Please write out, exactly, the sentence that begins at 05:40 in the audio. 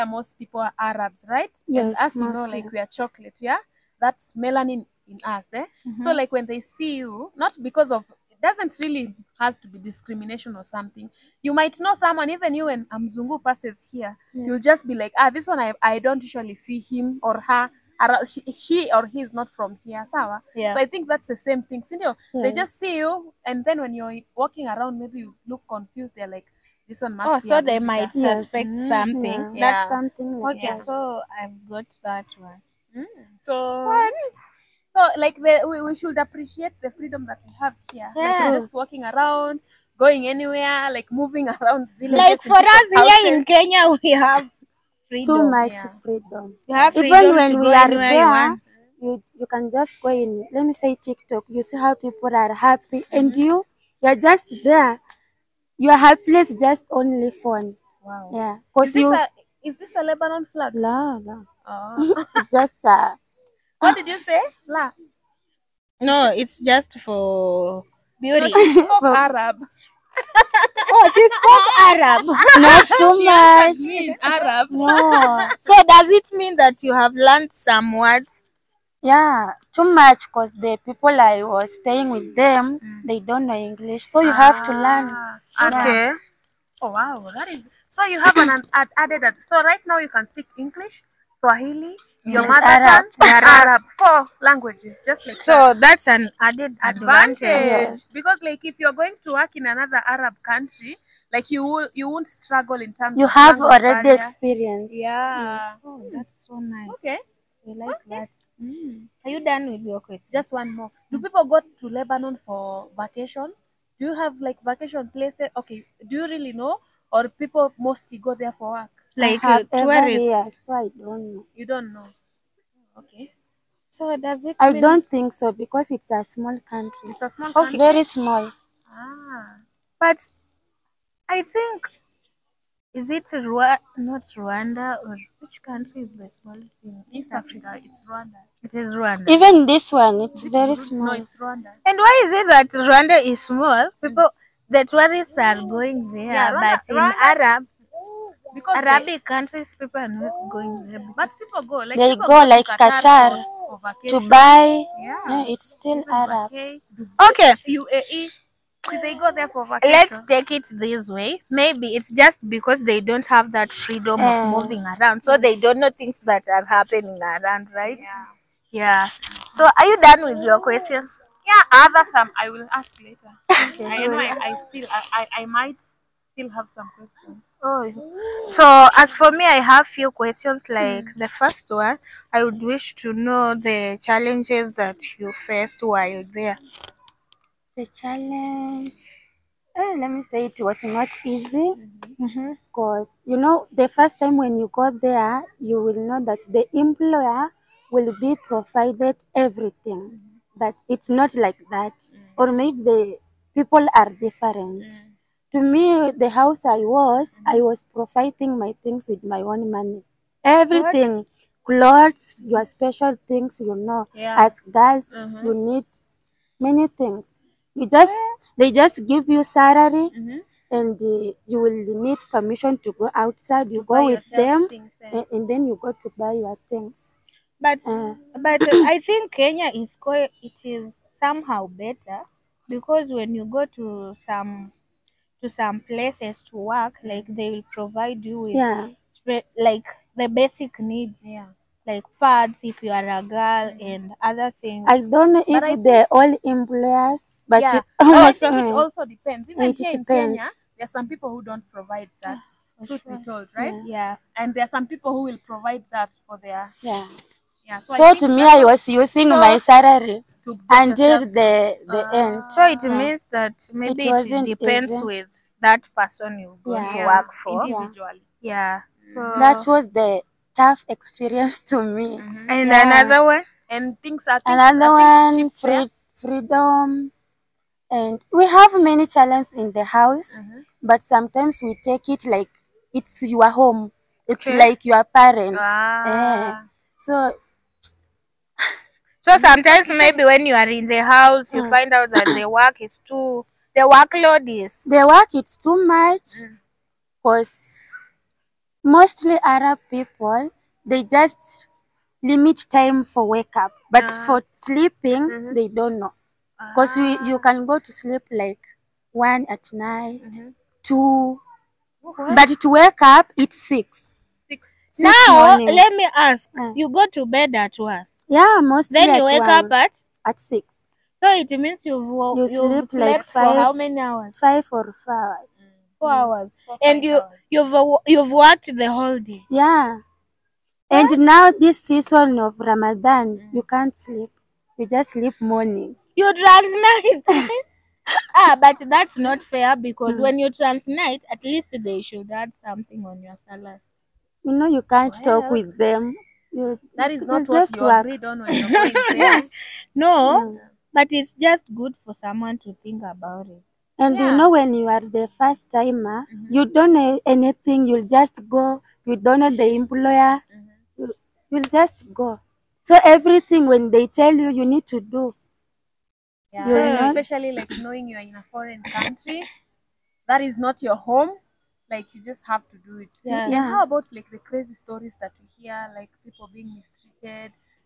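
when you trans night, at least they should add something on your salary.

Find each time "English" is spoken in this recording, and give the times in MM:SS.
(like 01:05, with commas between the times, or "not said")
01:23, 01:30.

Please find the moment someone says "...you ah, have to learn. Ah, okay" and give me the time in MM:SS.
01:24.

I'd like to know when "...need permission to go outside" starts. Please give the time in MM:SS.
03:42.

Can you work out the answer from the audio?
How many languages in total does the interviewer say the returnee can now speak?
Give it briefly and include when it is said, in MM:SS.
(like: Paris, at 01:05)
4, at 01:33.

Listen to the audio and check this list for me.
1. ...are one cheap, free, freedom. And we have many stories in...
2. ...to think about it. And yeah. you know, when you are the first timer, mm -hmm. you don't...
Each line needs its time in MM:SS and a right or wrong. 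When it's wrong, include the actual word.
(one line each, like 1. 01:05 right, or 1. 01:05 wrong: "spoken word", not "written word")
1. 04:34 wrong: "challenges", not "stories"
2. 05:52 right.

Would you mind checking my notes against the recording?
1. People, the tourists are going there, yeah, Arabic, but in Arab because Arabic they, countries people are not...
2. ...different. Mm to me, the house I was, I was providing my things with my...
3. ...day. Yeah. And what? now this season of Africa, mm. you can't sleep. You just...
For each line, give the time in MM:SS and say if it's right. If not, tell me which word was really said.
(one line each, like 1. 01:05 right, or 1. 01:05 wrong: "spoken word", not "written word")
1. 02:24 wrong: "Rwanda", not "Arabic"
2. 03:24 right
3. 05:29 wrong: "Ramadan", not "Africa".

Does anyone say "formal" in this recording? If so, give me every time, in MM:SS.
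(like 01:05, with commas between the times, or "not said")
not said.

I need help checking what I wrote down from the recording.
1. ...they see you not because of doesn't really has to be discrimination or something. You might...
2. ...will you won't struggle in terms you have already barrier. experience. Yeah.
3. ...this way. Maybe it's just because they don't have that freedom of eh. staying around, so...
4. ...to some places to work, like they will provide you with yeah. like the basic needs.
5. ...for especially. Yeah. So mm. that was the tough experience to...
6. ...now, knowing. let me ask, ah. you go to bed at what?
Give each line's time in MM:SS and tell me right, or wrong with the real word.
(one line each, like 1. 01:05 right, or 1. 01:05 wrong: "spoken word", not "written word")
1. 00:06 right
2. 01:41 right
3. 02:40 wrong: "moving", not "staying"
4. 03:55 right
5. 04:27 wrong: "individually", not "especially"
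6. 05:15 wrong: "morning", not "knowing".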